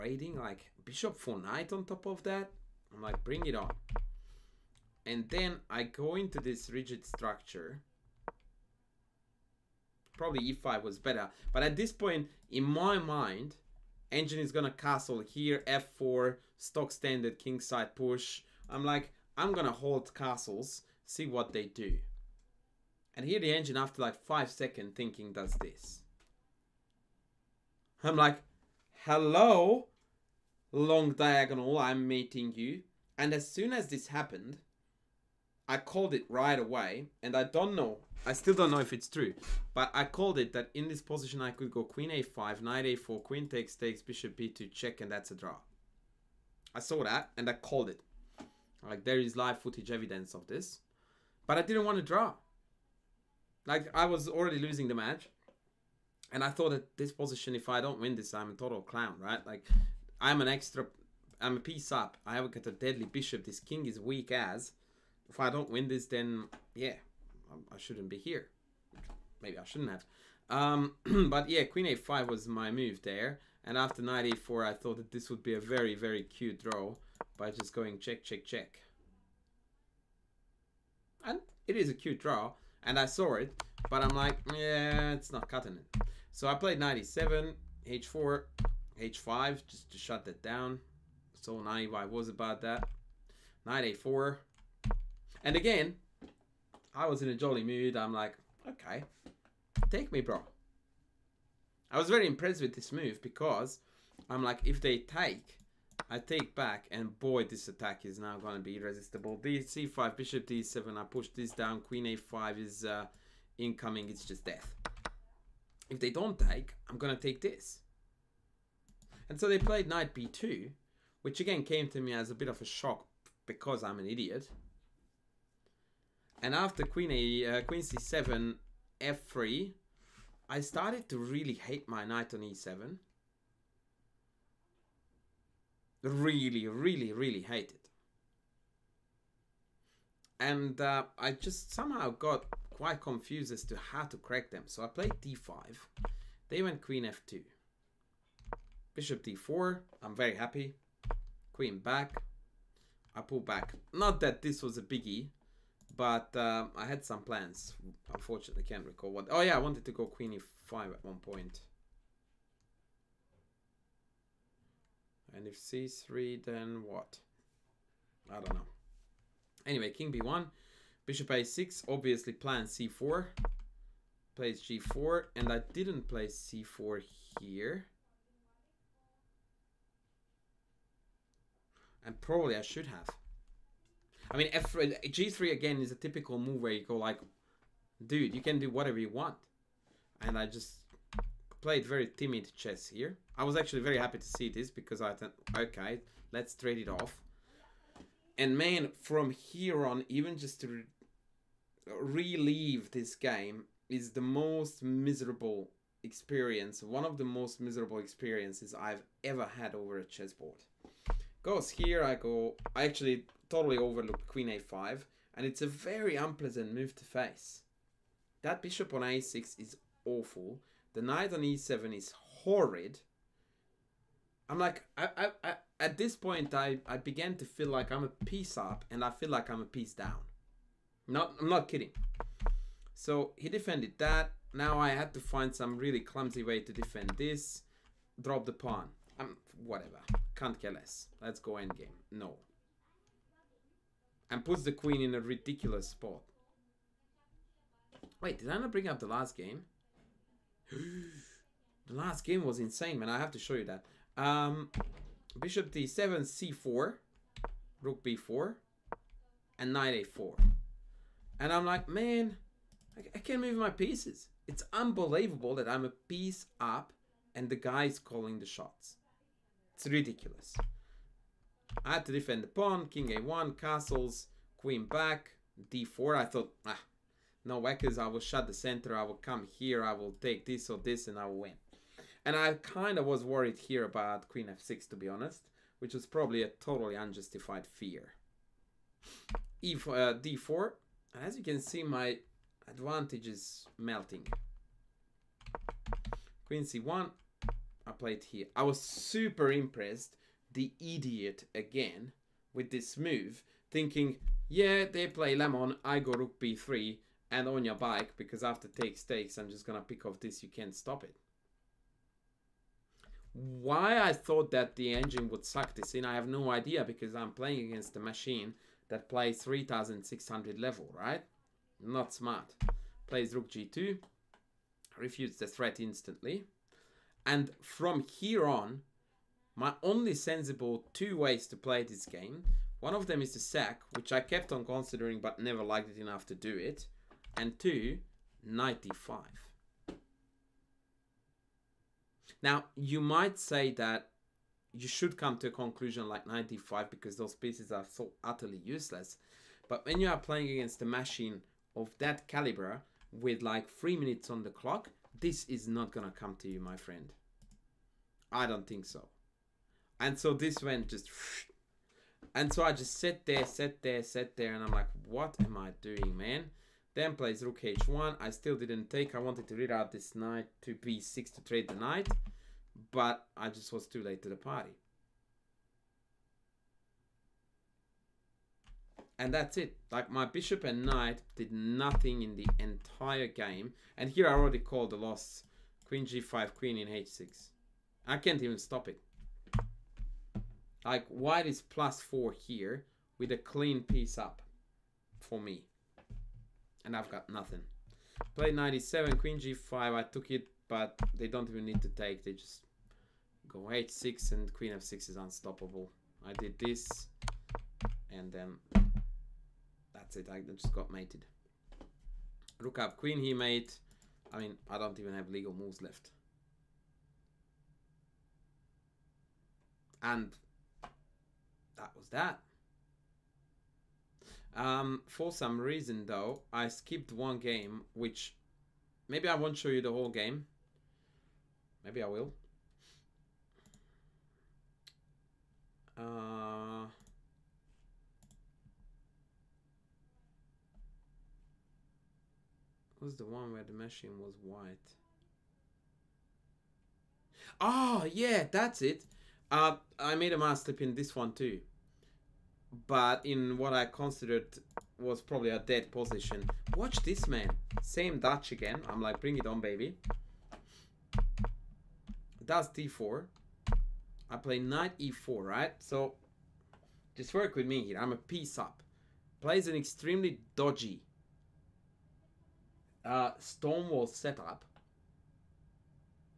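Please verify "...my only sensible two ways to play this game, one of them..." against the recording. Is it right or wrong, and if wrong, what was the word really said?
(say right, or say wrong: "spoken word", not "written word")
right.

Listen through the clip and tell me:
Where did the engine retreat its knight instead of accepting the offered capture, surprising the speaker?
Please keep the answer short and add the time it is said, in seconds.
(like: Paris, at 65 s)
b2, at 119 s.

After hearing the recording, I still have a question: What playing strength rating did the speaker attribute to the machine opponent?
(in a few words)
3600.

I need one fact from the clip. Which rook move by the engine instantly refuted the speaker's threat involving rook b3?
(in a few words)
Rook g2.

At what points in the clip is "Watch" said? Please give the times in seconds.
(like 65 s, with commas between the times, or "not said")
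456 s.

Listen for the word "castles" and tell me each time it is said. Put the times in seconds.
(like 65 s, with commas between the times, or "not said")
14 s, 20 s, 273 s.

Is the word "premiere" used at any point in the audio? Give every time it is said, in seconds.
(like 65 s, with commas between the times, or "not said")
not said.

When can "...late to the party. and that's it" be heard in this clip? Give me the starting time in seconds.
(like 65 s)
374 s.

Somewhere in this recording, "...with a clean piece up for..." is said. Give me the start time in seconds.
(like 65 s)
393 s.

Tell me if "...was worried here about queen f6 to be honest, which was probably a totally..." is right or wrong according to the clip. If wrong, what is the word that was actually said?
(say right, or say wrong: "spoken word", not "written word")
right.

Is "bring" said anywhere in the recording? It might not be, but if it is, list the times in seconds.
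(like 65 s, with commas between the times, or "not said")
3 s, 248 s, 459 s.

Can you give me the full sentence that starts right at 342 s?
Now, you might say that you should come to a conclusion like 95 because those pieces are so utterly useless.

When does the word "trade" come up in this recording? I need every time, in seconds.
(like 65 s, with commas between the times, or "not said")
196 s, 371 s.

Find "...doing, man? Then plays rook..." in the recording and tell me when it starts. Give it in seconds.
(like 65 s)
365 s.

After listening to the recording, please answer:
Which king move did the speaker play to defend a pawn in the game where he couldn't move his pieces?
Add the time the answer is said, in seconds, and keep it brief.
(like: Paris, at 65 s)
king a1, at 272 s.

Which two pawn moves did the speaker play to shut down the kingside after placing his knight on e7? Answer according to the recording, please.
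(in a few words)
h4, h5.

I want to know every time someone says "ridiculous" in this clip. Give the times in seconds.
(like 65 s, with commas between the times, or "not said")
245 s, 269 s.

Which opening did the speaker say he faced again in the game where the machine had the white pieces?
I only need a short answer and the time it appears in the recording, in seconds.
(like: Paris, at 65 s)
Dutch, at 458 s.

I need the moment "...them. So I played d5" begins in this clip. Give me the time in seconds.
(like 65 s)
144 s.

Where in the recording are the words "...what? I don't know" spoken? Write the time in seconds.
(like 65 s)
166 s.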